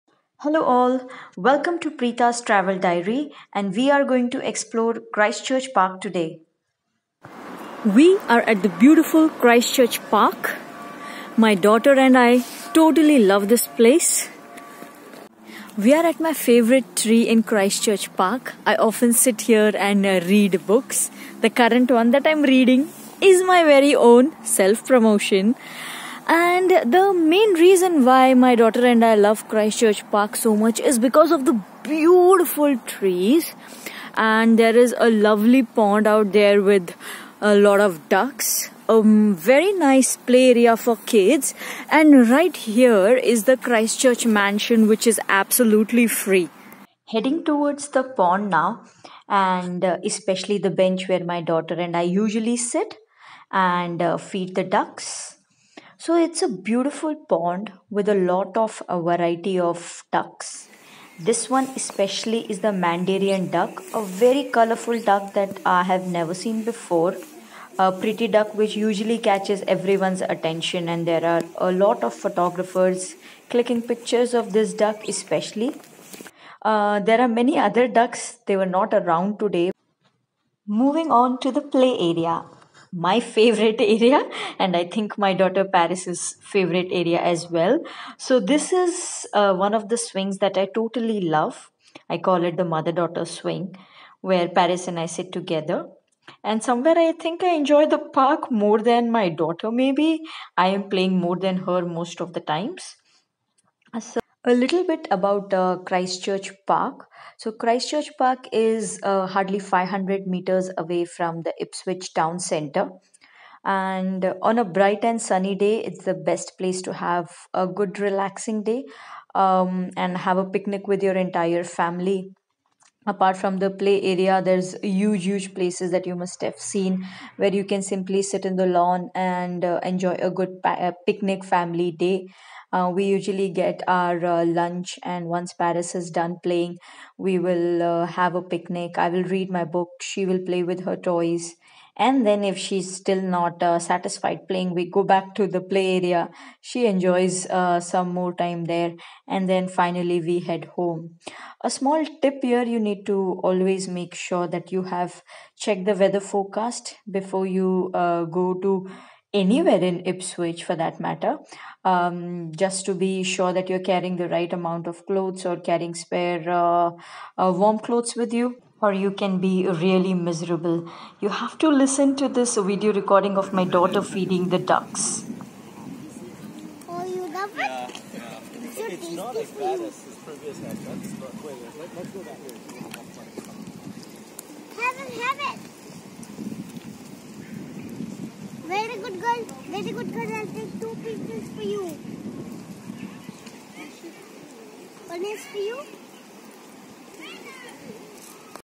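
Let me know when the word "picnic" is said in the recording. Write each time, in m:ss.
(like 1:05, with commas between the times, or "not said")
2:00, 2:11, 2:18.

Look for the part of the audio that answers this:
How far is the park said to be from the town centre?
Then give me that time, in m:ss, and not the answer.
1:49.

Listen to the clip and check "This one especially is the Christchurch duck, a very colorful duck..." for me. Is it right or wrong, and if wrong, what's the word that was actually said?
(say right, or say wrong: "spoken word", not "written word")
wrong: "Mandarin", not "Christchurch".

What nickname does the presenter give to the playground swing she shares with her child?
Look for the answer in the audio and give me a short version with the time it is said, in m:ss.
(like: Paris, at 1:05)
mother daughter swing, at 1:32.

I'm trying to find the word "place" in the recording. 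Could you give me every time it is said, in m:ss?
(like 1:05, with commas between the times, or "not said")
0:13, 1:56, 2:05.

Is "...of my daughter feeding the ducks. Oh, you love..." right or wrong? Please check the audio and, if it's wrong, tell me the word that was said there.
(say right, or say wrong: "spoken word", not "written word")
right.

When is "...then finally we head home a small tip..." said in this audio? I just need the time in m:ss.
2:29.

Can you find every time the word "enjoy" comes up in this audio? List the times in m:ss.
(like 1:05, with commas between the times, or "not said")
1:37, 2:09, 2:26.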